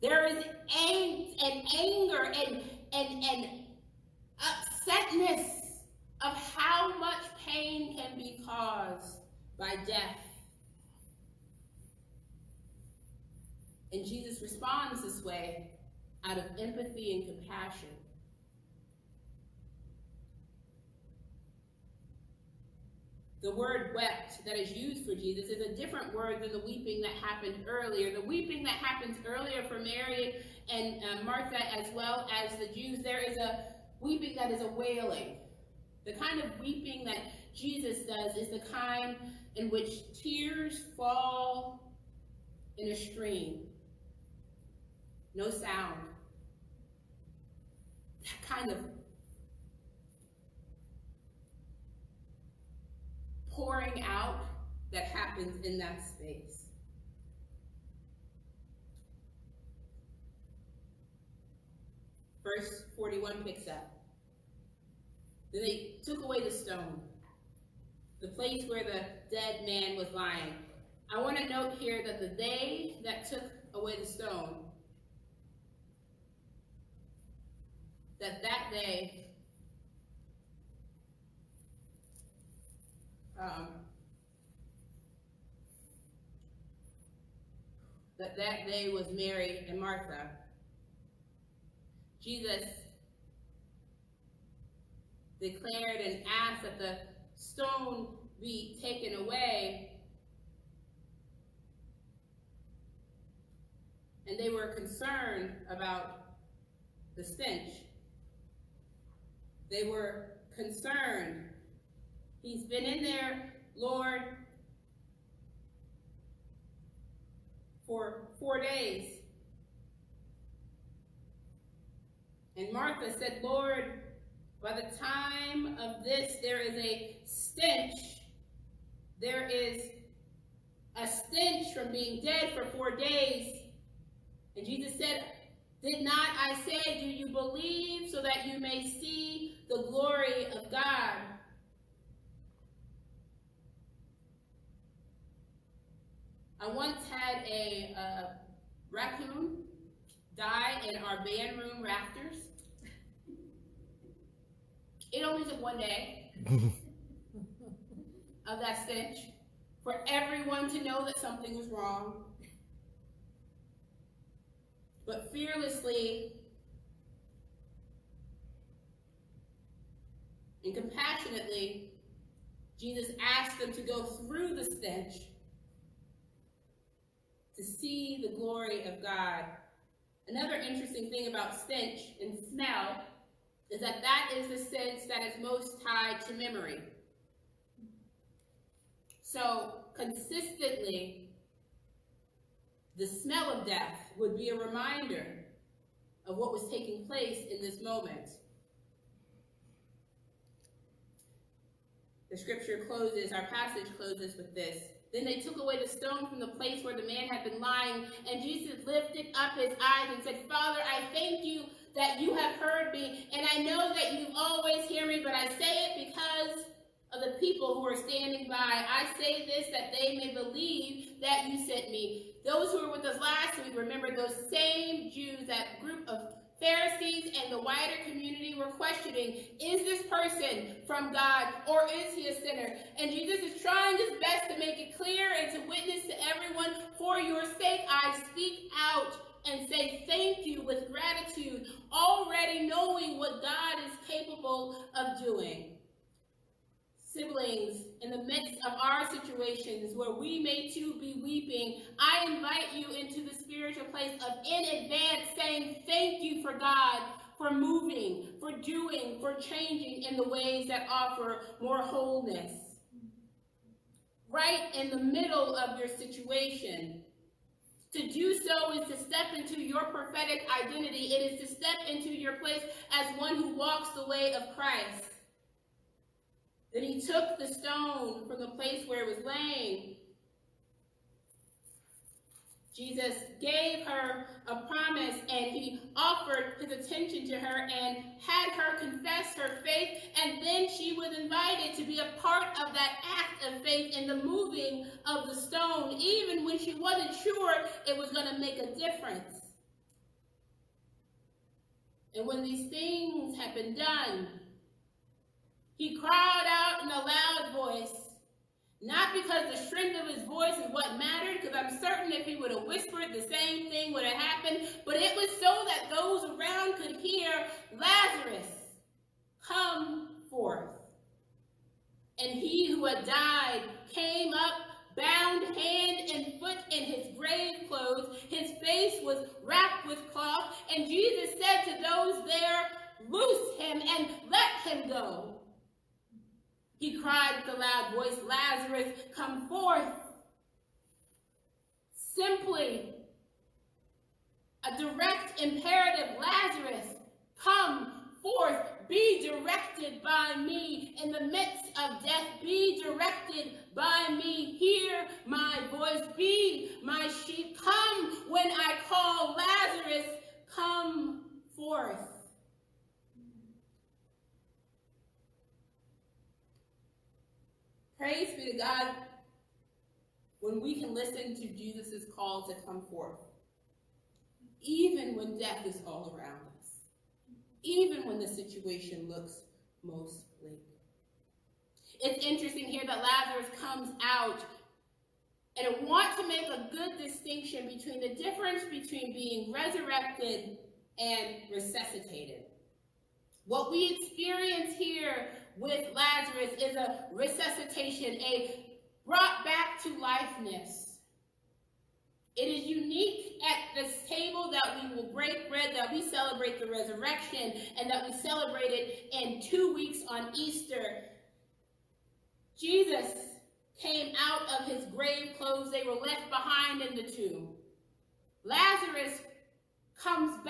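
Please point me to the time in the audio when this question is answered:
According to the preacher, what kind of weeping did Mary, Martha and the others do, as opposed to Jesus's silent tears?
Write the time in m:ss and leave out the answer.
0:34.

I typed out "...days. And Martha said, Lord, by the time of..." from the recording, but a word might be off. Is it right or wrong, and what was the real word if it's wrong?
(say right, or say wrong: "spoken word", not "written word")
right.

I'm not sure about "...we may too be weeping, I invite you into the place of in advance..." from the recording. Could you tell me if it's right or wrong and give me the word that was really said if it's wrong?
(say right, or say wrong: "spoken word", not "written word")
right.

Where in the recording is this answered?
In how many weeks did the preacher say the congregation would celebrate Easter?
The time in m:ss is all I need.
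6:49.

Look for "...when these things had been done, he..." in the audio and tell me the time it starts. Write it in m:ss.
5:02.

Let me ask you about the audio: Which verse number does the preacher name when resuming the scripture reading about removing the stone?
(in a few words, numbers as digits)
41.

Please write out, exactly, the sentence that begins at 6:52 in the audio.
Jesus came out of his grave clothes.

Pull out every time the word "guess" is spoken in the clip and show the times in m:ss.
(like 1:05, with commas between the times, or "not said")
not said.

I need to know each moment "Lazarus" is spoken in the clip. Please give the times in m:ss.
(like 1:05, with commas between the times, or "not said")
5:17, 5:38, 5:46, 5:59, 6:23, 6:35, 6:58.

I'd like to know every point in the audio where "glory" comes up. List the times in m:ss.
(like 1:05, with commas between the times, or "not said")
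2:19, 2:58.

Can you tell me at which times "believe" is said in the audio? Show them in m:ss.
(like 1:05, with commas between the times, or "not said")
2:17, 3:40.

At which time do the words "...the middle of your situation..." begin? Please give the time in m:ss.
4:24.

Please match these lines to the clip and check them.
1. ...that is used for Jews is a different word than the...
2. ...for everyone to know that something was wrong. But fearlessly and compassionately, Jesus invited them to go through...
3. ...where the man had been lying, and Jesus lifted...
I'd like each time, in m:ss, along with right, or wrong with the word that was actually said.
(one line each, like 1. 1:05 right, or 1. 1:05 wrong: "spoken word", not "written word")
1. 0:24 wrong: "Jesus", not "Jews"
2. 2:39 wrong: "asked", not "invited"
3. 3:26 right.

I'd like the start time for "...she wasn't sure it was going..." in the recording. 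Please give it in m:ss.
4:56.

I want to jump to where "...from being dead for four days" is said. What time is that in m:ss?
2:11.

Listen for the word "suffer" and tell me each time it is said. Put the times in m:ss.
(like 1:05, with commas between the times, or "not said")
not said.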